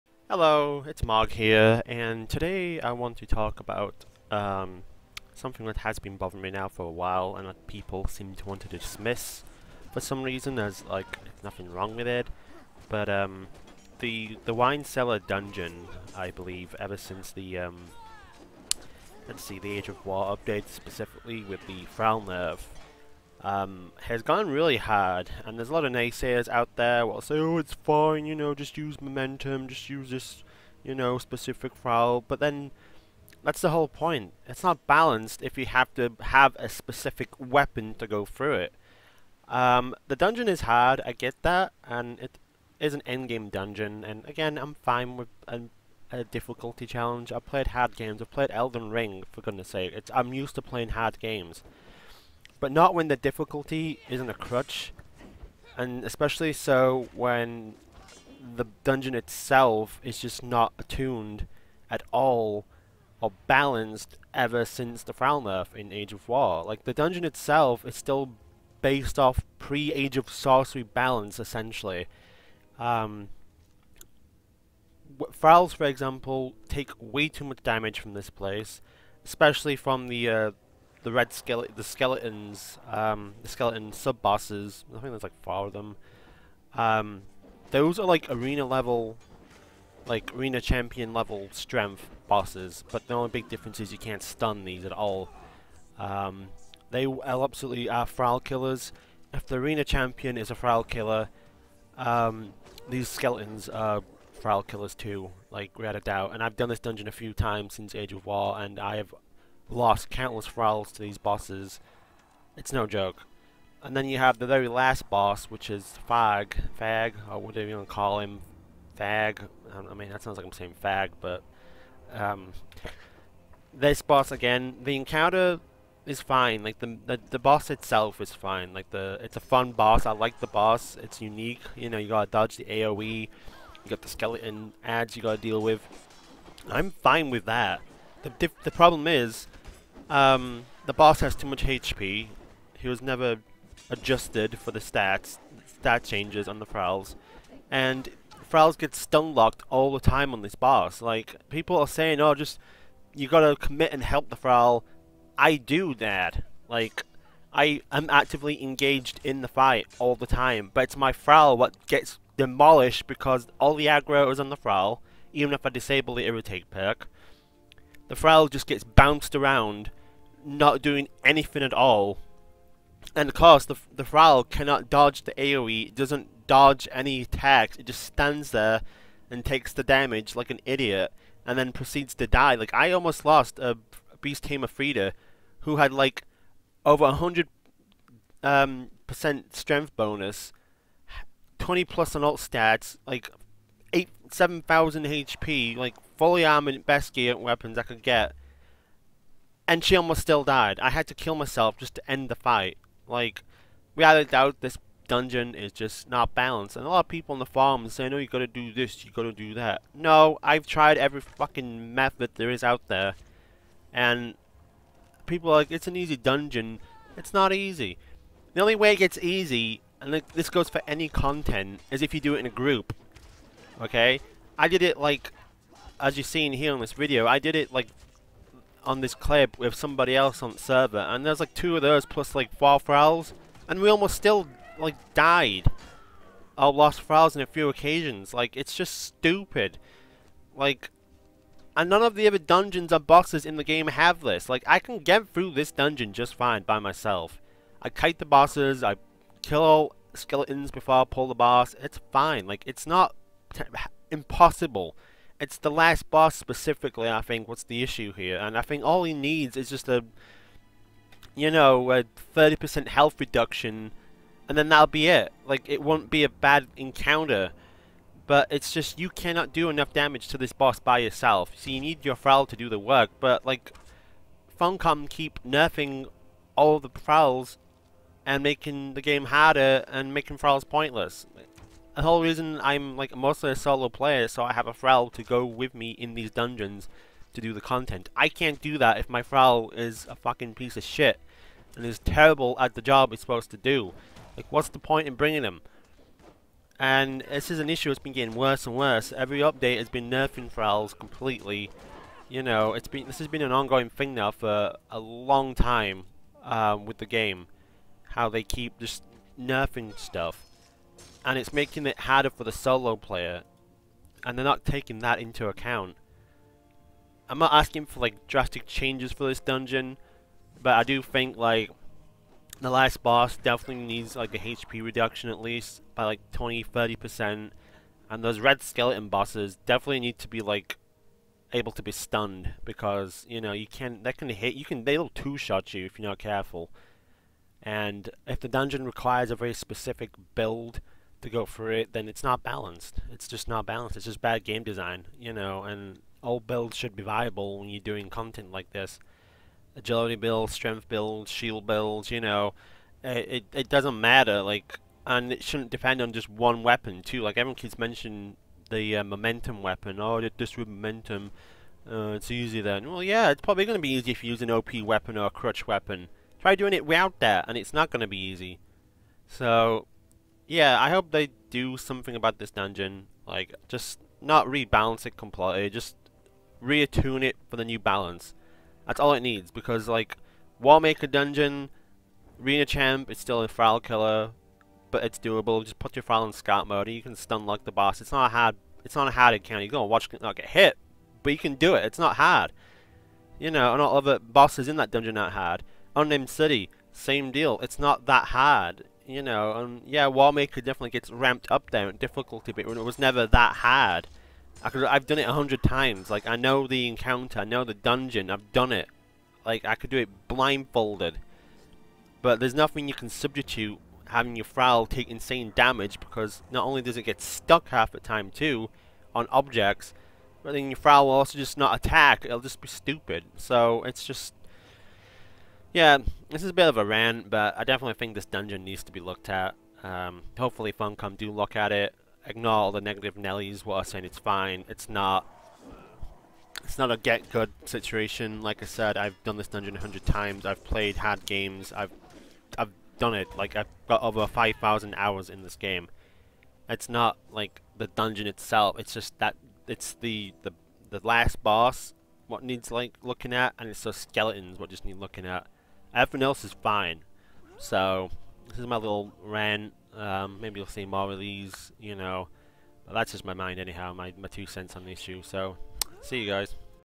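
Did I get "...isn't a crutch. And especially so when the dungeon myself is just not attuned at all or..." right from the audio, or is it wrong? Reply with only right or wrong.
wrong.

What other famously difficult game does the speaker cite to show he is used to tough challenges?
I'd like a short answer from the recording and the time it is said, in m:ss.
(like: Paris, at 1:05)
Elden Ring, at 0:48.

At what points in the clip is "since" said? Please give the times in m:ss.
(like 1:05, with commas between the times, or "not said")
0:16, 1:04, 1:47.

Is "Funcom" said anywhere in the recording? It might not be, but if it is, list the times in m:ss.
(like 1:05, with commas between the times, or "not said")
4:34, 7:10.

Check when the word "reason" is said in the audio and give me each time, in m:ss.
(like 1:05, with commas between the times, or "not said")
0:10, 4:42.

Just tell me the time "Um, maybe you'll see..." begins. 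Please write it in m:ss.
7:39.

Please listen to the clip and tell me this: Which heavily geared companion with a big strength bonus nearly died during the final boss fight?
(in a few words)
Beast Tamer Frida.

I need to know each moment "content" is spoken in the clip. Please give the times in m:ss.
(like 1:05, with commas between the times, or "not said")
3:41, 4:47, 5:48.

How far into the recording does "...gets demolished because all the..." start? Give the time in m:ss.
2:41.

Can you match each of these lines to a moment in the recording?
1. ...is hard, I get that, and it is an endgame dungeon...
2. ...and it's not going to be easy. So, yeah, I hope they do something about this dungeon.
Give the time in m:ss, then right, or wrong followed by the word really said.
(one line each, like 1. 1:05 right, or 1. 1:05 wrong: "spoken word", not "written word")
1. 0:40 right
2. 6:07 right.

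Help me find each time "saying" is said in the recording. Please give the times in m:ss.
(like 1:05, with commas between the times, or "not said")
2:00, 2:31, 7:13.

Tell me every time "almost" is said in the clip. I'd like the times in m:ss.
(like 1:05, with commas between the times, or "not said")
3:02, 3:19, 3:53.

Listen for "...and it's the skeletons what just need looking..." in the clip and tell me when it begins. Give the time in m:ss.
7:33.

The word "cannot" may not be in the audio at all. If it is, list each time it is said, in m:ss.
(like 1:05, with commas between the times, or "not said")
2:54, 4:29.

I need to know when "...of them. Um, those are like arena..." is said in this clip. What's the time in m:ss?
1:25.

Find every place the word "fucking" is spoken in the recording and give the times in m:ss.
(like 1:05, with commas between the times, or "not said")
3:31, 4:50.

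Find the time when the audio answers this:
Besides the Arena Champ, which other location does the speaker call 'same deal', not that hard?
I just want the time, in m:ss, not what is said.
6:35.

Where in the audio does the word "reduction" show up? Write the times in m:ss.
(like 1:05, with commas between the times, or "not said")
4:23, 5:24.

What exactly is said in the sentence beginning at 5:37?
And if the dungeon requires a very specific build to go for it, then it's not balanced.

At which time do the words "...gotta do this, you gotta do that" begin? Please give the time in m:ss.
3:28.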